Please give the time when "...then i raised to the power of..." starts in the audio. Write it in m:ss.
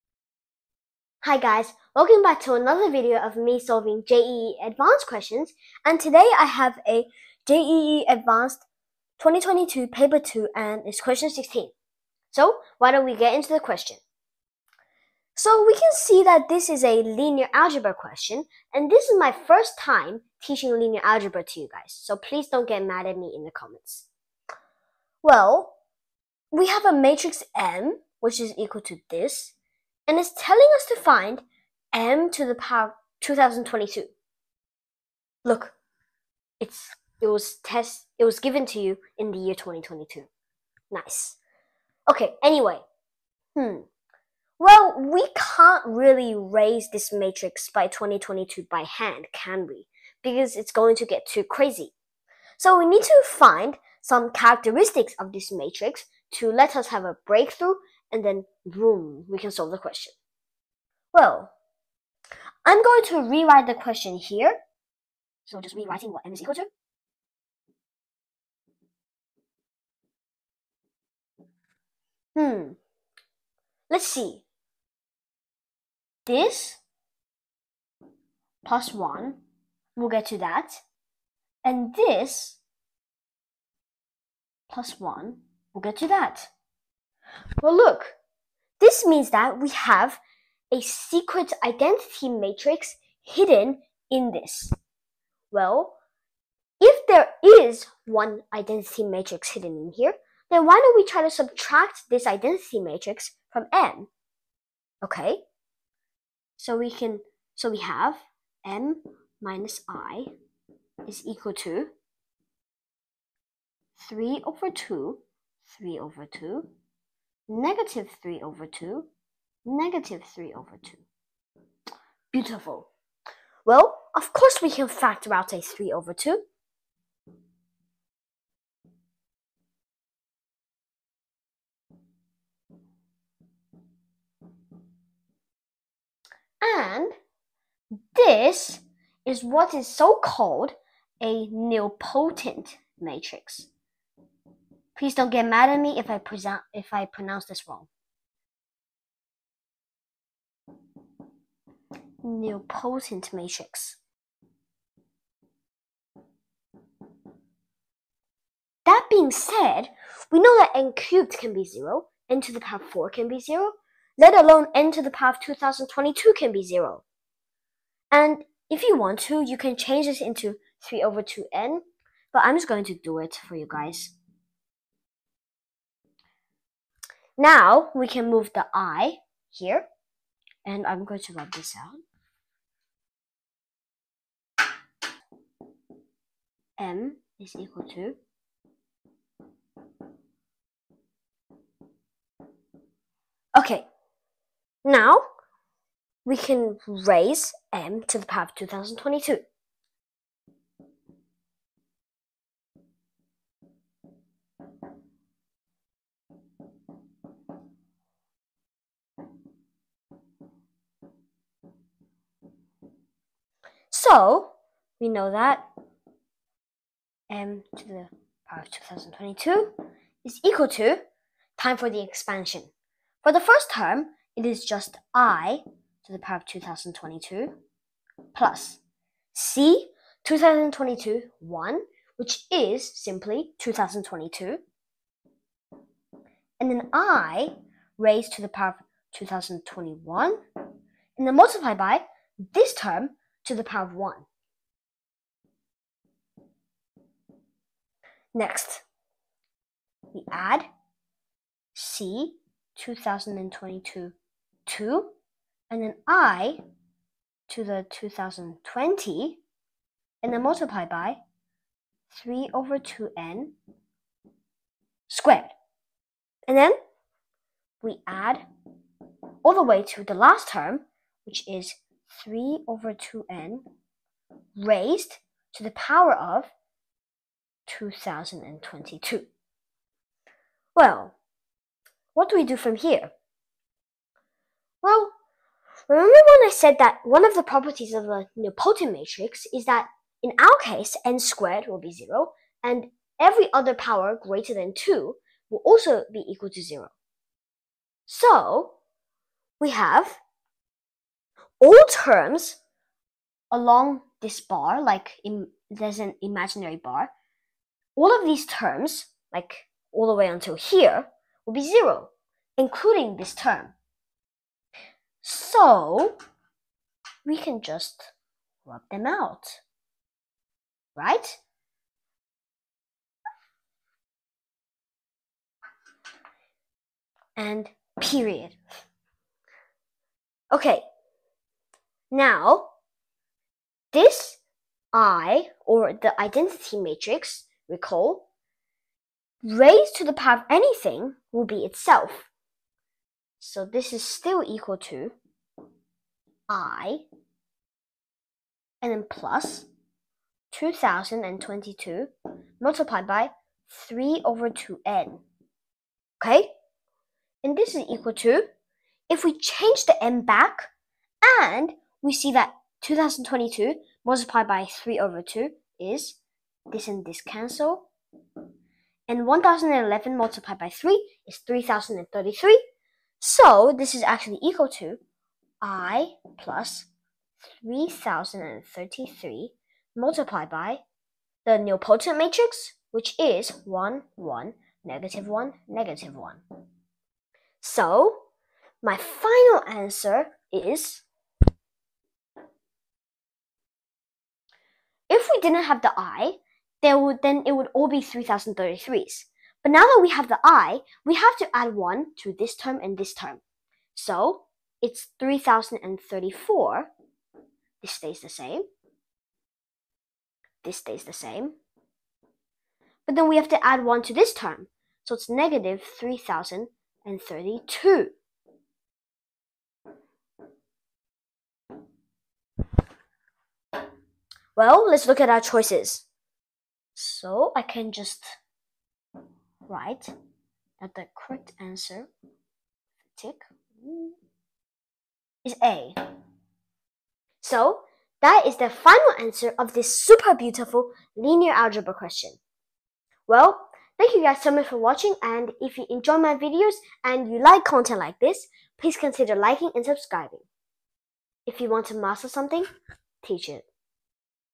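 3:56.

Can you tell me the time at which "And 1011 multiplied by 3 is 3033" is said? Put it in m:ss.
6:09.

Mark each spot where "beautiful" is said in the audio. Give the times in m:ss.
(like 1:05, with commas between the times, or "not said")
2:02, 7:20.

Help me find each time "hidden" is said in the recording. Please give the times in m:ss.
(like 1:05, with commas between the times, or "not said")
1:33, 1:39.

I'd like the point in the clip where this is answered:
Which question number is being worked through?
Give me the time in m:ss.
0:10.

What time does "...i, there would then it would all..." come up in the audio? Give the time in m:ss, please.
6:35.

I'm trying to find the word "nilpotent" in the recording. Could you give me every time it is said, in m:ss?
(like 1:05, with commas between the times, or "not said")
2:21, 4:48, 6:21.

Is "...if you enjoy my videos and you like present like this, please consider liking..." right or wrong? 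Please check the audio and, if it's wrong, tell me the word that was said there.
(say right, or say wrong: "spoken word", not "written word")
wrong: "content", not "present".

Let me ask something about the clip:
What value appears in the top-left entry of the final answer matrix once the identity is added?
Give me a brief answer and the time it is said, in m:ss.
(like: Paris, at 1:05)
3034, at 6:45.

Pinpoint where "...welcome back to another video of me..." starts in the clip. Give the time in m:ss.
0:01.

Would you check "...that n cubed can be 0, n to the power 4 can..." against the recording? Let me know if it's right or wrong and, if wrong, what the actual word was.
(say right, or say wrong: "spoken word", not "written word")
right.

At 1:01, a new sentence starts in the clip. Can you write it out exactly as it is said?
Well, I'm going to rewrite the question here.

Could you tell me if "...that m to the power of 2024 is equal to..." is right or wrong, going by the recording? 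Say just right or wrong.
wrong.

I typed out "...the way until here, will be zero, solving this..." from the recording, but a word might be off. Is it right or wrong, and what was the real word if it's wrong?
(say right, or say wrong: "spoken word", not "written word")
wrong: "including", not "solving".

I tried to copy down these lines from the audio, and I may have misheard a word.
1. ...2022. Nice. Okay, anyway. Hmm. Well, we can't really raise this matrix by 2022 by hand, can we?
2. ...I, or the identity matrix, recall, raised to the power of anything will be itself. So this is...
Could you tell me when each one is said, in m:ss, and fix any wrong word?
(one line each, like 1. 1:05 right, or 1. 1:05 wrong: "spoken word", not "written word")
1. 0:39 right
2. 5:34 right.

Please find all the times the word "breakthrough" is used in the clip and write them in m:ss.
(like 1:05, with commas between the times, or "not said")
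0:57.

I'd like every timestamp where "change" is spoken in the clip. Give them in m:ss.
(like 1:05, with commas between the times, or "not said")
2:49, 5:59.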